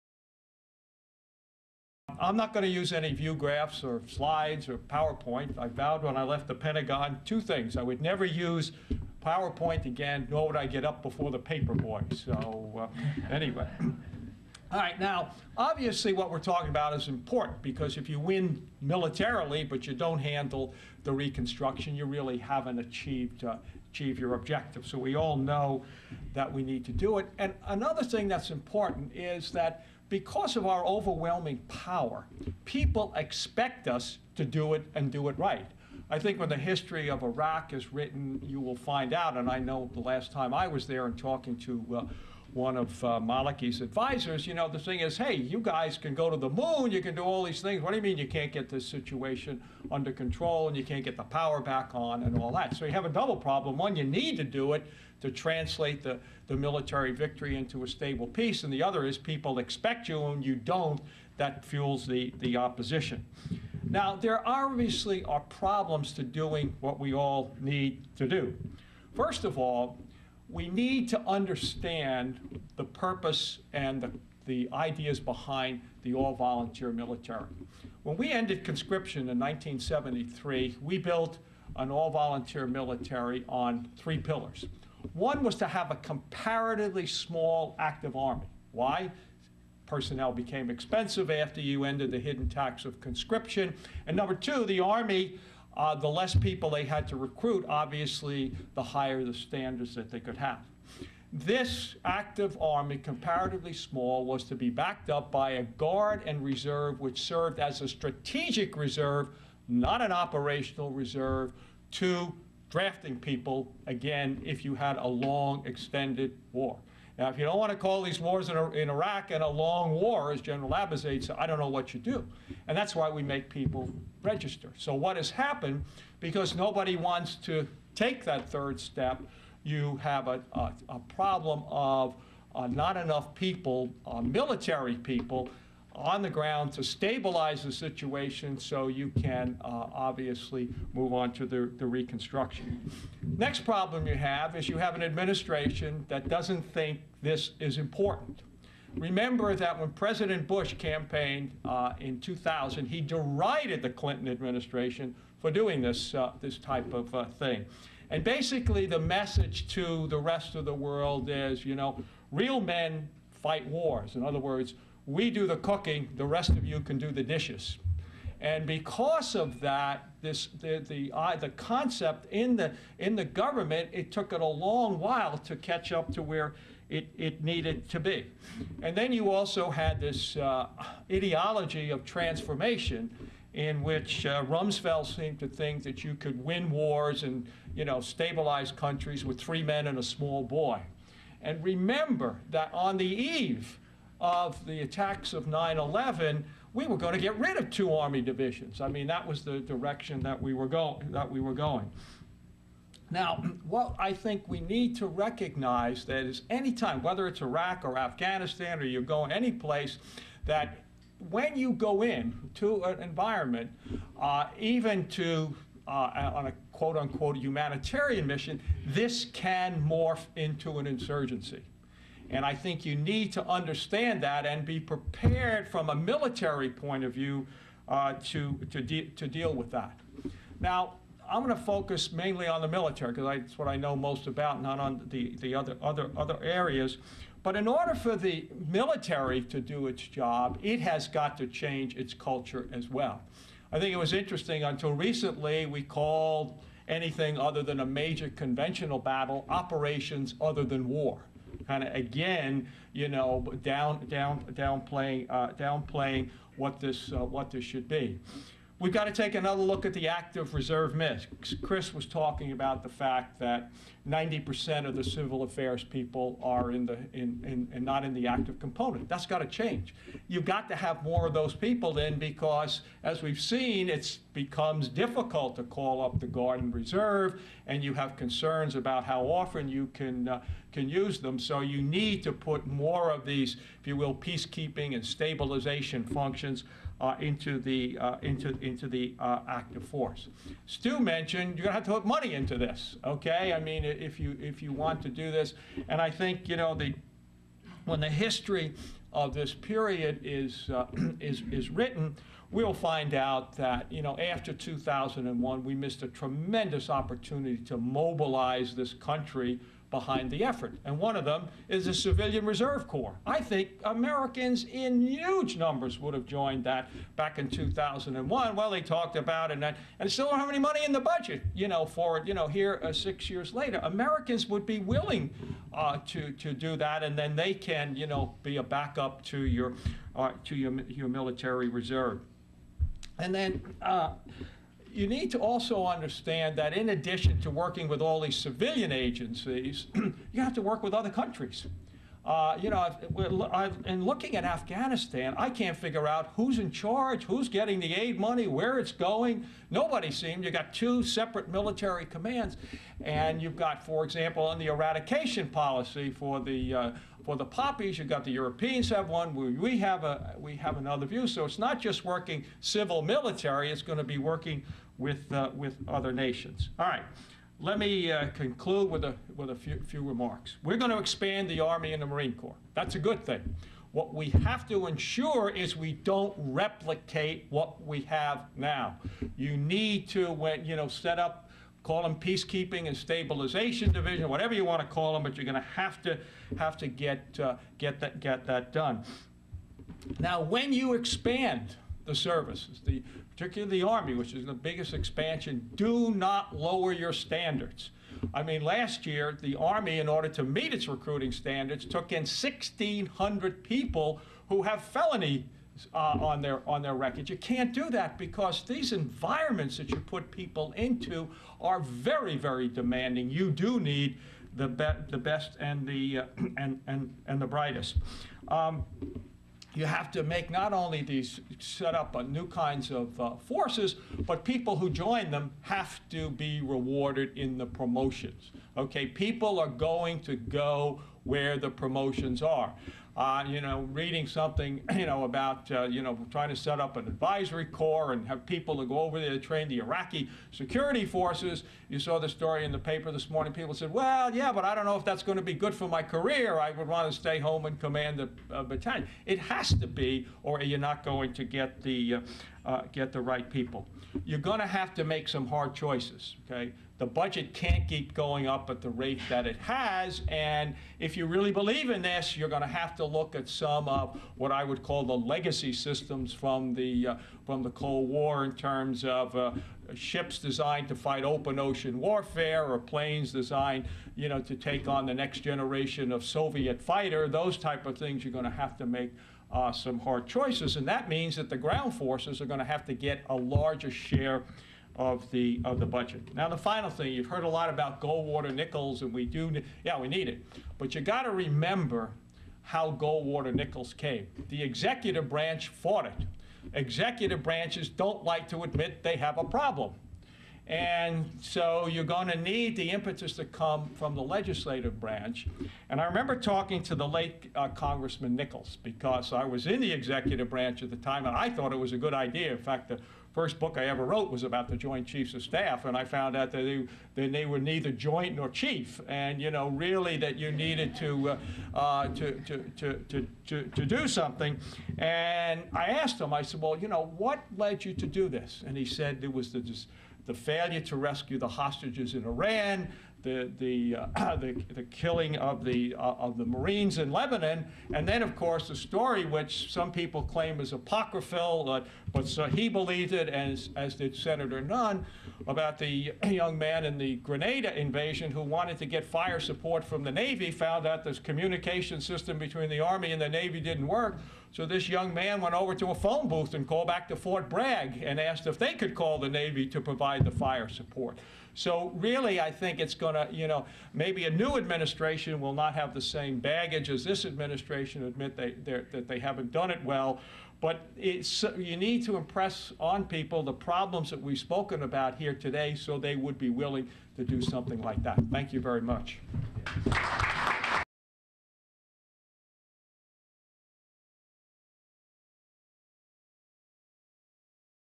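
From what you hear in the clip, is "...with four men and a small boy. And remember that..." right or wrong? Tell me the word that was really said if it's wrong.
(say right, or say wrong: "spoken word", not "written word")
wrong: "three", not "four".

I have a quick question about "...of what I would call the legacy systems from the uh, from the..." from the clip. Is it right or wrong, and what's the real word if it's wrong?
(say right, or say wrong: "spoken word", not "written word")
right.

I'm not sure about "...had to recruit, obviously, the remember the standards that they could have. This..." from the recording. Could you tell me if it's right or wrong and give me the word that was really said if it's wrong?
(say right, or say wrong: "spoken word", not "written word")
wrong: "higher", not "remember".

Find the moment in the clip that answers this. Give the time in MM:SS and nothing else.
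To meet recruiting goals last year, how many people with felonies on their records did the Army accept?
06:42.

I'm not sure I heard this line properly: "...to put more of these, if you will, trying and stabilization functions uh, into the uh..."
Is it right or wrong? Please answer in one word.
wrong.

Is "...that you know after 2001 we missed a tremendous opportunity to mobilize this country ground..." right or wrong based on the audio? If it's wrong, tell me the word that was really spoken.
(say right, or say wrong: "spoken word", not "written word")
wrong: "behind", not "ground".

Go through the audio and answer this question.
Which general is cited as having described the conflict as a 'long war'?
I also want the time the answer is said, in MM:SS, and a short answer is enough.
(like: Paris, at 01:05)
General Abizaid, at 02:00.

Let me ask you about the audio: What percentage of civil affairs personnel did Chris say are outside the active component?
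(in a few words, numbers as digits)
90%.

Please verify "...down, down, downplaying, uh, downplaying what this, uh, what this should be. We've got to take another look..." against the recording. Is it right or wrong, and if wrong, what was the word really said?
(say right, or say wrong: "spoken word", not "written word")
right.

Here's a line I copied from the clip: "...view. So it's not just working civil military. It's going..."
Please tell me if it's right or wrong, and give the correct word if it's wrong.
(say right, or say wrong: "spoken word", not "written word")
right.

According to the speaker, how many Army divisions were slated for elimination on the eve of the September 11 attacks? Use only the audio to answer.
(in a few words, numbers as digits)
2.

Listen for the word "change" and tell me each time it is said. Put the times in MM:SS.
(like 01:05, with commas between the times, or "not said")
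04:01, 04:29.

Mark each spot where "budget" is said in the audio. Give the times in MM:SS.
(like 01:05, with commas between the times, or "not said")
05:20, 07:37, 08:05.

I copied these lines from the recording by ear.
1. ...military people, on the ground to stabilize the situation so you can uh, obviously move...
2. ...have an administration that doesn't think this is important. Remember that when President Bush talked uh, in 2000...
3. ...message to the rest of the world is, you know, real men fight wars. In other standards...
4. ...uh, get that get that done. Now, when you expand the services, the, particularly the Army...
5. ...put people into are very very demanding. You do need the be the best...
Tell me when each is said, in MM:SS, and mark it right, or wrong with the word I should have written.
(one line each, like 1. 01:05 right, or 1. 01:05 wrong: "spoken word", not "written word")
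1. 02:14 right
2. 02:24 wrong: "campaigned", not "talked"
3. 02:38 wrong: "words", not "standards"
4. 06:27 right
5. 06:49 right.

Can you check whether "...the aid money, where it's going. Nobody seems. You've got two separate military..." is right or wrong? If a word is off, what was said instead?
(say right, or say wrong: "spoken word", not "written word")
right.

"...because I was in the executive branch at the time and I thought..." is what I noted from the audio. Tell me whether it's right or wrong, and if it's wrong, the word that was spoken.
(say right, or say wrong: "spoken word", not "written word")
right.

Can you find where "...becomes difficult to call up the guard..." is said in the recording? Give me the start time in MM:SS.
04:34.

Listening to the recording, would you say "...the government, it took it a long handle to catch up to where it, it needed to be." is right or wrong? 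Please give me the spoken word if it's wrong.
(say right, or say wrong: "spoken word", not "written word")
wrong: "while", not "handle".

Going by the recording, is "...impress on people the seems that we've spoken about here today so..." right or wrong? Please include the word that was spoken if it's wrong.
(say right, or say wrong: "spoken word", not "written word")
wrong: "problems", not "seems".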